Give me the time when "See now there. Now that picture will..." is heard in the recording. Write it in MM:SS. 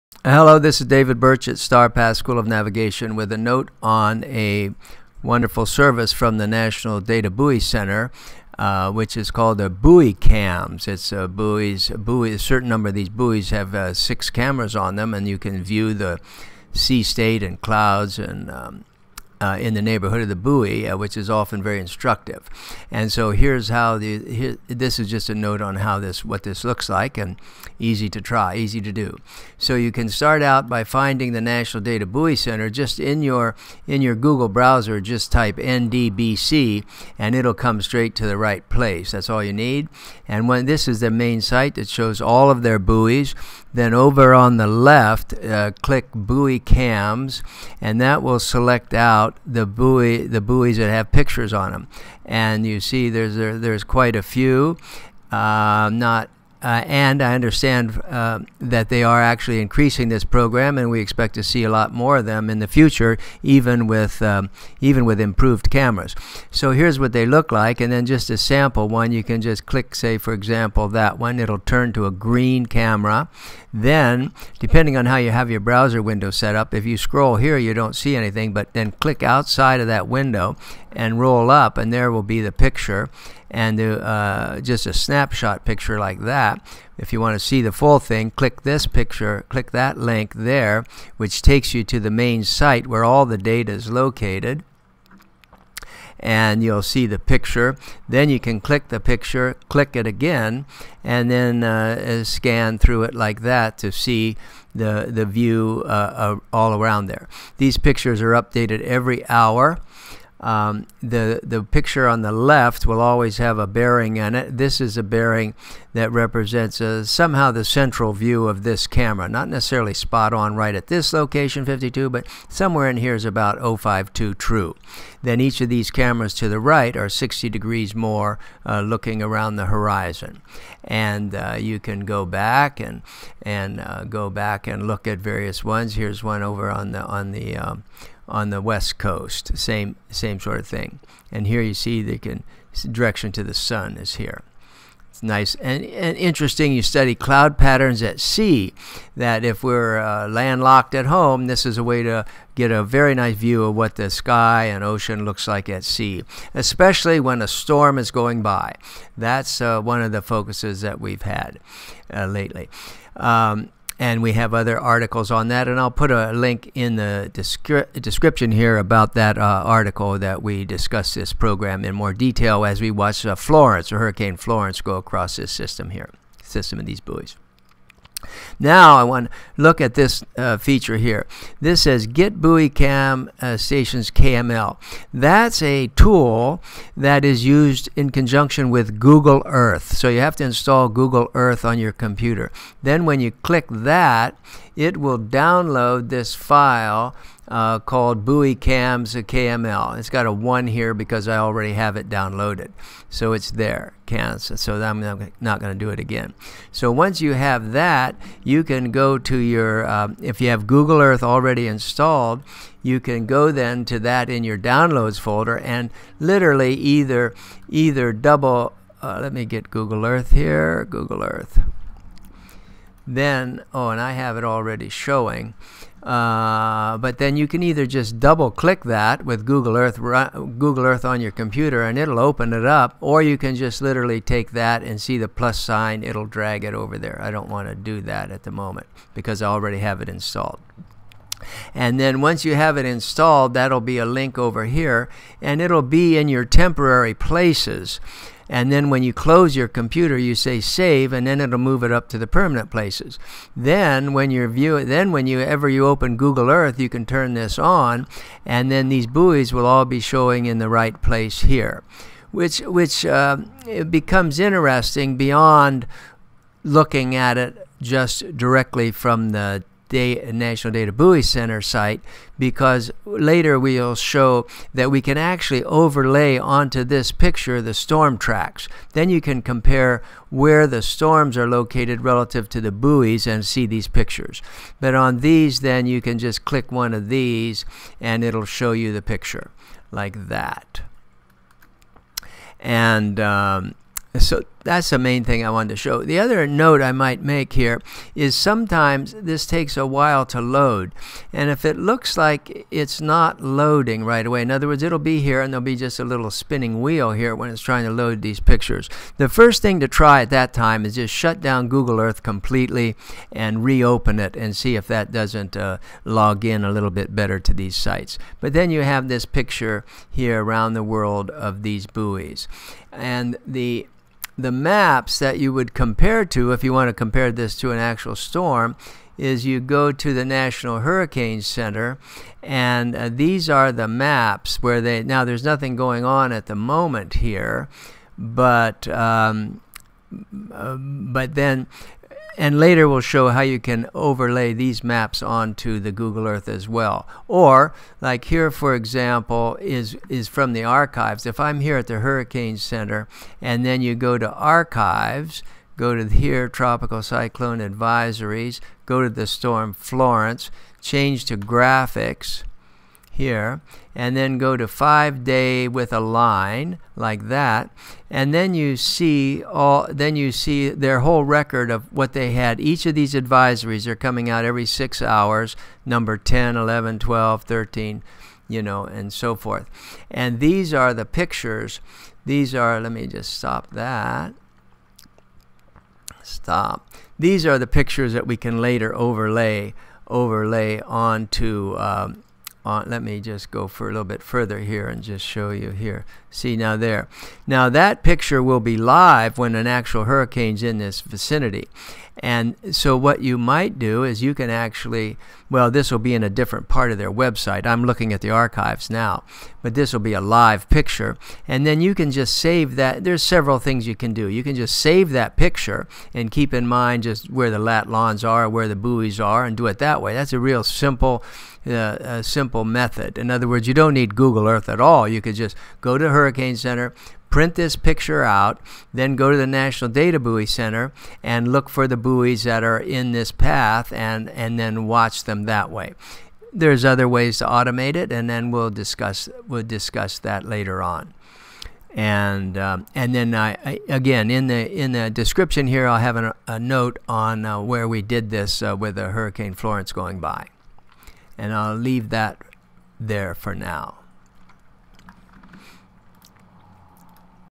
06:36.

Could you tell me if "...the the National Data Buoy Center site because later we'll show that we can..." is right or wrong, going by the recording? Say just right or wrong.
right.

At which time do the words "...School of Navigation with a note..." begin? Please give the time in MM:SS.
00:02.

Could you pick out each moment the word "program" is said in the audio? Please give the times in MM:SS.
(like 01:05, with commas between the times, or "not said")
01:00, 02:51.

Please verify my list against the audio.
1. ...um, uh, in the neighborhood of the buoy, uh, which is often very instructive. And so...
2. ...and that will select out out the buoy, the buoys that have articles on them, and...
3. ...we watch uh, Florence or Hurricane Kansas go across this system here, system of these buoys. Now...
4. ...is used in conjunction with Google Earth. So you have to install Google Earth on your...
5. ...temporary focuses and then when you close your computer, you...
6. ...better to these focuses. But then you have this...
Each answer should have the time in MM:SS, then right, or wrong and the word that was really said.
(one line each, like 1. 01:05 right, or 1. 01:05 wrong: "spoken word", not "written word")
1. 00:18 right
2. 00:47 wrong: "pictures", not "articles"
3. 02:52 wrong: "Florence", not "Kansas"
4. 03:07 right
5. 04:06 wrong: "places", not "focuses"
6. 05:17 wrong: "sites", not "focuses".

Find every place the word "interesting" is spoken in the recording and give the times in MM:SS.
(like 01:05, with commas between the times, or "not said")
02:26, 04:24.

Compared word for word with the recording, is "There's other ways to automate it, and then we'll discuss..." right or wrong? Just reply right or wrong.
right.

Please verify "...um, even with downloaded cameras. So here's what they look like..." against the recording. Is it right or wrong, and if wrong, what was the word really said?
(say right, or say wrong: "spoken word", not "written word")
wrong: "improved", not "downloaded".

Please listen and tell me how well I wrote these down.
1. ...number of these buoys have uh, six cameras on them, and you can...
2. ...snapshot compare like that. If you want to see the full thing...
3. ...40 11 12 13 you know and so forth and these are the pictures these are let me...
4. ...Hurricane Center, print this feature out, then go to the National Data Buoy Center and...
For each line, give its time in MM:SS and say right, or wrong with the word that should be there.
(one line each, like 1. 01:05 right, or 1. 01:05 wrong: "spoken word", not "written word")
1. 00:12 right
2. 01:24 wrong: "picture", not "compare"
3. 06:16 wrong: "10", not "40"
4. 07:06 wrong: "picture", not "feature".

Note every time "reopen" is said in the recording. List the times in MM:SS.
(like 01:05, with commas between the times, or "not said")
05:13.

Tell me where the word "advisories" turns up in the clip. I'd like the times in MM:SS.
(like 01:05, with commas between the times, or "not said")
05:57, 06:13.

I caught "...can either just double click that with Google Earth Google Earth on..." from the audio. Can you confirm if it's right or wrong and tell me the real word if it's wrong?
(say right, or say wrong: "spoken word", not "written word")
right.